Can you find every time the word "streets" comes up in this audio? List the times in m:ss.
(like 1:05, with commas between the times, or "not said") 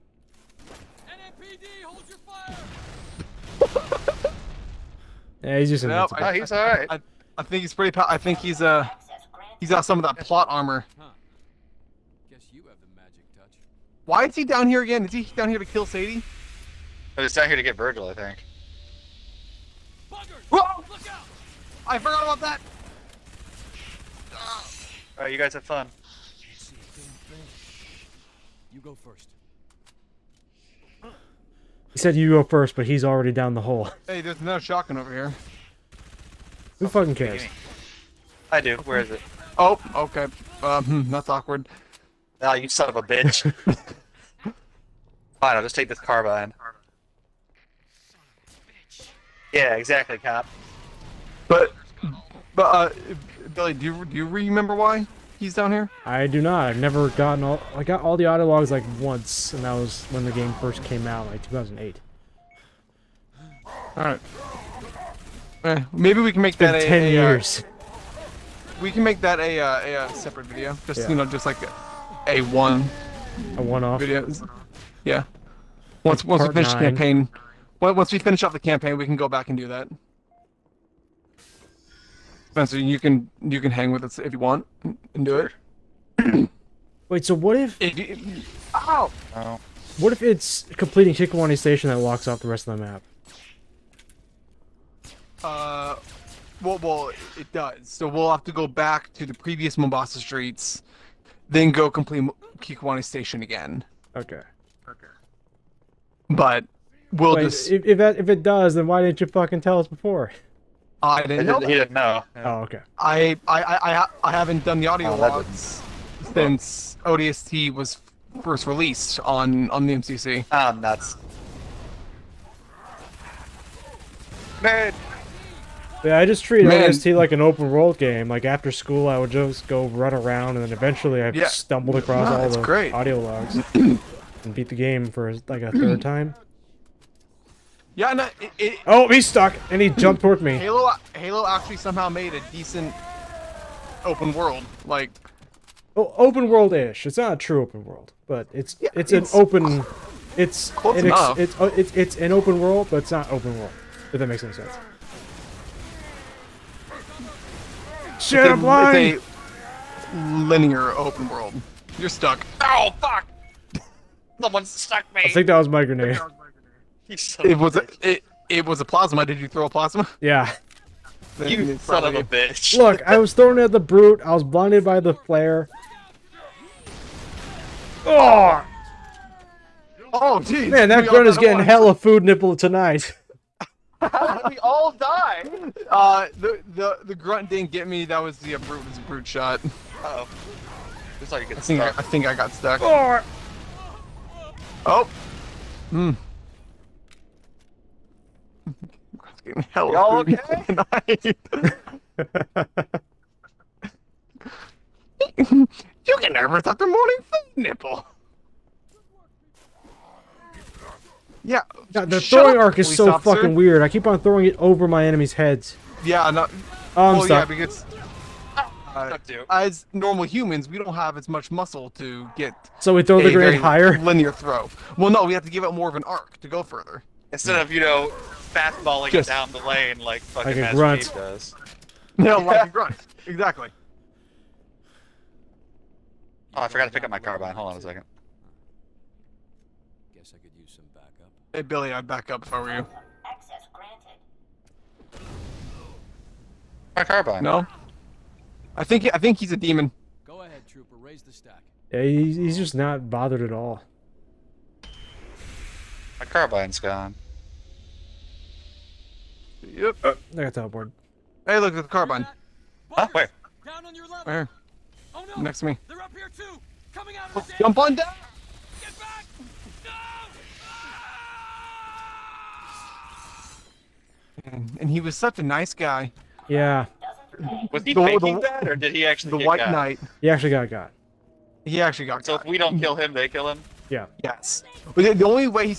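1:40.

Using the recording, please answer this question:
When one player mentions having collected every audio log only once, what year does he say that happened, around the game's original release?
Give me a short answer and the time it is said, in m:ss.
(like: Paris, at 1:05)
2008, at 1:01.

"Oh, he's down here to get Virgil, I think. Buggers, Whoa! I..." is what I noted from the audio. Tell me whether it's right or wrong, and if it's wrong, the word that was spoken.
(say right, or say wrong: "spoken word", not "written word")
right.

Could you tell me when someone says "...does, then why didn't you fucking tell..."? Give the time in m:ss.
1:48.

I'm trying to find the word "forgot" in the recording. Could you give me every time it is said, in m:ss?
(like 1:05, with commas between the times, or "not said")
0:21, 3:56.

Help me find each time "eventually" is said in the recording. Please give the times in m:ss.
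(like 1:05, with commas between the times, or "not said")
2:10.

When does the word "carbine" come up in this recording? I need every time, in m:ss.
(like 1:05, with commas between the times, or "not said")
0:46, 3:57, 4:07, 4:16, 4:21.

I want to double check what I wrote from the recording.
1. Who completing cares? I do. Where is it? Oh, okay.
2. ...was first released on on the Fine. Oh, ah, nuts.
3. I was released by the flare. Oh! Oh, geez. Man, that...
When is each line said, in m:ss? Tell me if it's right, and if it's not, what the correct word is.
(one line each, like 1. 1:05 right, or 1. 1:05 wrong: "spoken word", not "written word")
1. 0:36 wrong: "fucking", not "completing"
2. 1:57 wrong: "MCC", not "Fine"
3. 2:54 wrong: "blinded", not "released".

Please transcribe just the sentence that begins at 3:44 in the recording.
Well, no, we have to give it more of an arc to go further.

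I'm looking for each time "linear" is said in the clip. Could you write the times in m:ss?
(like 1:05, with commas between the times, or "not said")
2:40, 3:43.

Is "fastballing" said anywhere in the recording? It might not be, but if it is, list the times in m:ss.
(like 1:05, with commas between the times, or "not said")
3:48.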